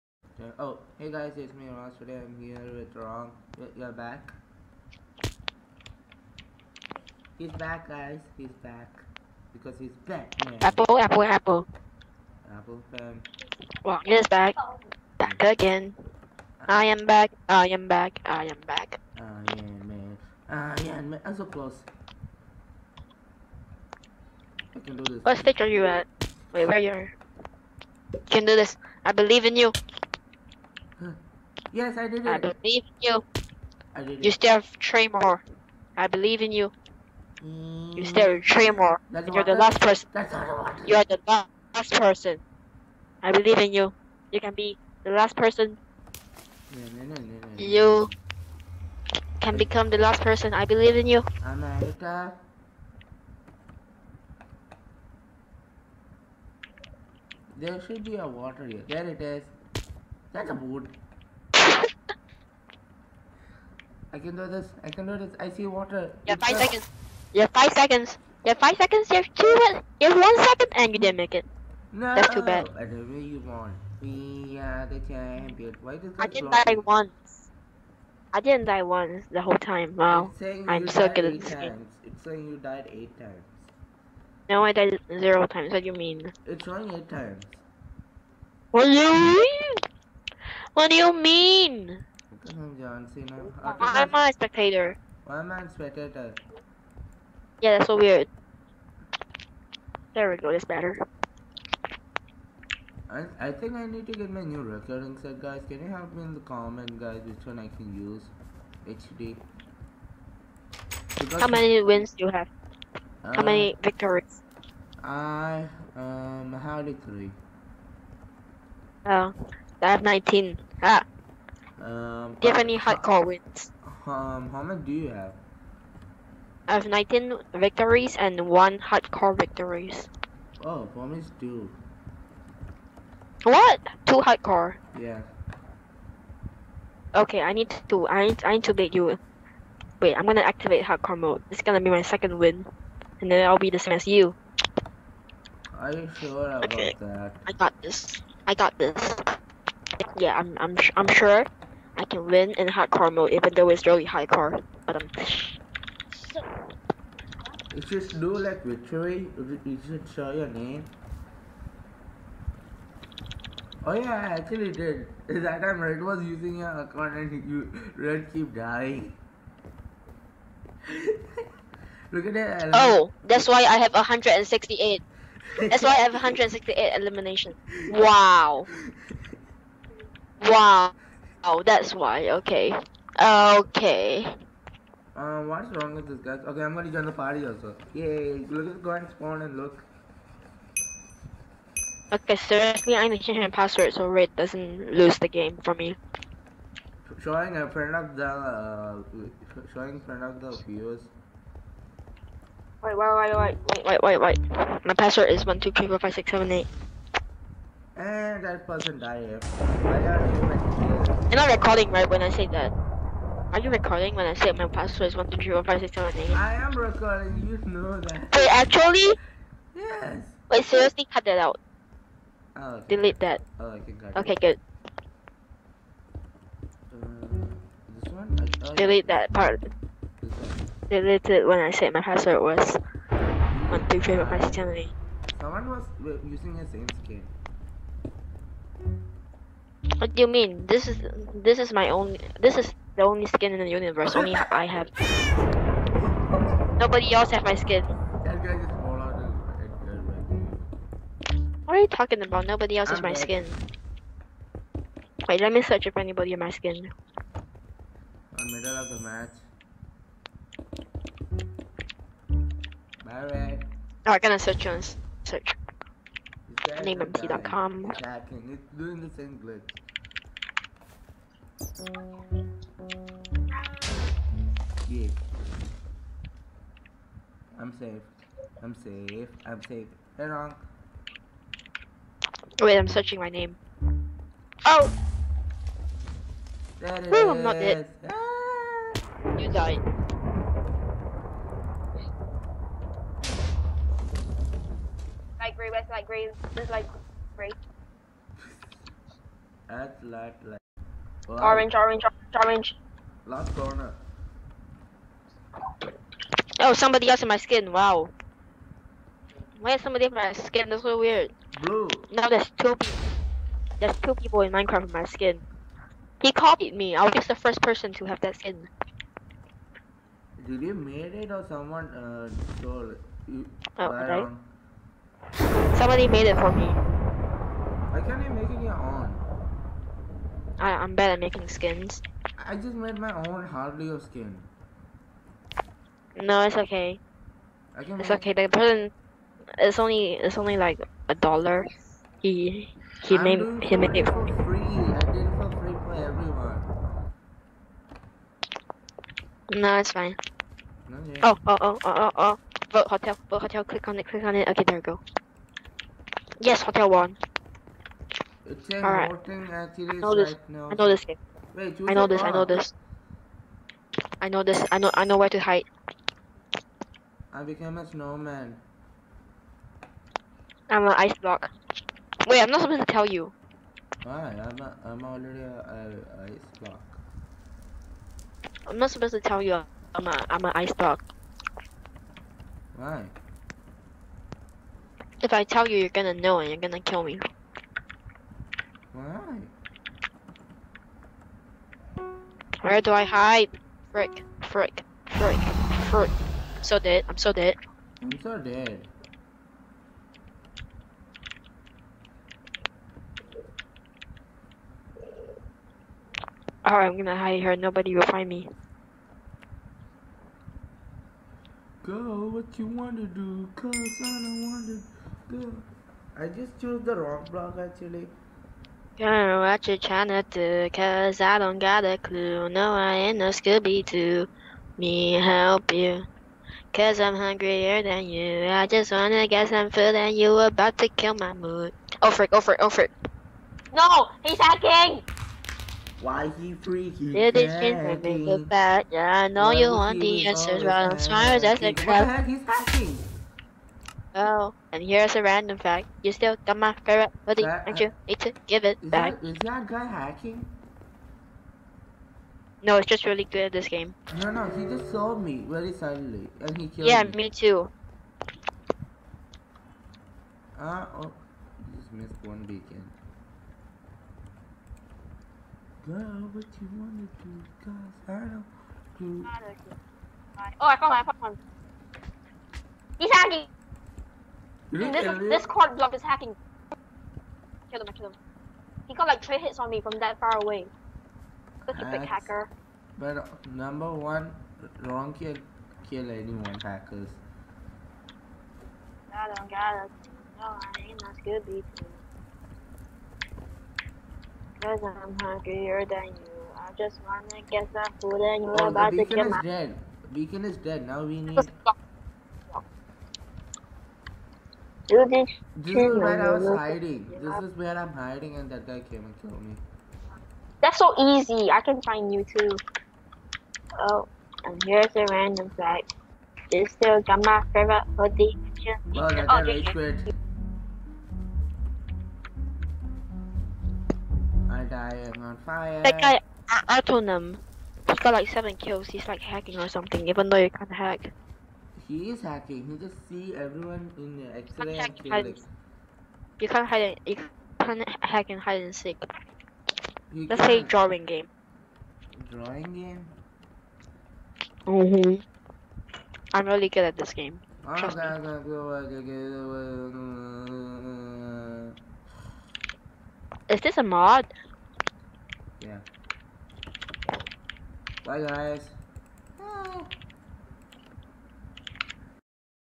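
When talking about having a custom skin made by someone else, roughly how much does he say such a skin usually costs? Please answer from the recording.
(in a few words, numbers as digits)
a dollar.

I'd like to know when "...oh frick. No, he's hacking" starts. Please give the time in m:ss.
7:12.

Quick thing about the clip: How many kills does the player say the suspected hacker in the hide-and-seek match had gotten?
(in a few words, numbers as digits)
7.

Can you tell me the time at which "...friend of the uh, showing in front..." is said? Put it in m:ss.
3:17.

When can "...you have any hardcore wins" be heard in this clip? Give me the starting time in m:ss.
2:02.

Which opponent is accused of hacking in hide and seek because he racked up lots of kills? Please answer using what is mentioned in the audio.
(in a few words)
Atonum.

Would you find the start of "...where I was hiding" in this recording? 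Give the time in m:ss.
8:25.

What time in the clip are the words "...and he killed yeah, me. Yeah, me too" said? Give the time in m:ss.
7:36.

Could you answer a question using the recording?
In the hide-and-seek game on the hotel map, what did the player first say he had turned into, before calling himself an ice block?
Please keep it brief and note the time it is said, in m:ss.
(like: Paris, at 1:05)
snowman, at 6:07.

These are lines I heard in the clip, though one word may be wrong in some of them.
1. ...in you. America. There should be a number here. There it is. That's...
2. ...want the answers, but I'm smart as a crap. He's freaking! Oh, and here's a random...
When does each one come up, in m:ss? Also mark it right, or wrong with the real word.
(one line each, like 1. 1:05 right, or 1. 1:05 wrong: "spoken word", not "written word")
1. 0:50 wrong: "water", not "number"
2. 7:19 wrong: "hacking", not "freaking".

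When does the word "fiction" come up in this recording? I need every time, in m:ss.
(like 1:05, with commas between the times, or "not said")
not said.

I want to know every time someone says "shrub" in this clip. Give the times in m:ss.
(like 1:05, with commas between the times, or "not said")
not said.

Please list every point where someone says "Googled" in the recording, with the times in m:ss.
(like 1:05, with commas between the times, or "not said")
not said.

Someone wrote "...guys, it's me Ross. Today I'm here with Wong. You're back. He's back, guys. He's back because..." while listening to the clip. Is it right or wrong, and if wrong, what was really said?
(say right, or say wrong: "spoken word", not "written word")
right.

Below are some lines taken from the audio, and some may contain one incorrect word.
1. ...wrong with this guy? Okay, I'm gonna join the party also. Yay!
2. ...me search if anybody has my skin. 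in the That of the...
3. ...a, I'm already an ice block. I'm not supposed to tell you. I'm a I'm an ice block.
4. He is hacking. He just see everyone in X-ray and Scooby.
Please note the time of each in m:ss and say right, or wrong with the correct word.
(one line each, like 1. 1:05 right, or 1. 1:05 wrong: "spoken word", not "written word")
1. 3:05 right
2. 4:15 wrong: "Middle", not "That"
3. 6:14 right
4. 8:51 wrong: "Felix", not "Scooby".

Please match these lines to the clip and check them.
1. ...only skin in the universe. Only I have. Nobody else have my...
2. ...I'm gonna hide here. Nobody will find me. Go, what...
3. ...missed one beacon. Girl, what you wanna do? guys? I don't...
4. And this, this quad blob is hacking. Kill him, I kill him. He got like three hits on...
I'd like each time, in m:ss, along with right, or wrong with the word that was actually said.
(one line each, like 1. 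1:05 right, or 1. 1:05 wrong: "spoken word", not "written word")
1. 4:03 right
2. 6:46 right
3. 7:41 right
4. 7:54 right.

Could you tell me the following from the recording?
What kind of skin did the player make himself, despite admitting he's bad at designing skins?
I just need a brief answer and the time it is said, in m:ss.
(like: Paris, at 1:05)
Harley skin, at 5:33.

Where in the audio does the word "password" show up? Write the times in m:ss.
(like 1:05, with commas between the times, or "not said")
3:13, 3:24, 3:34, 3:52.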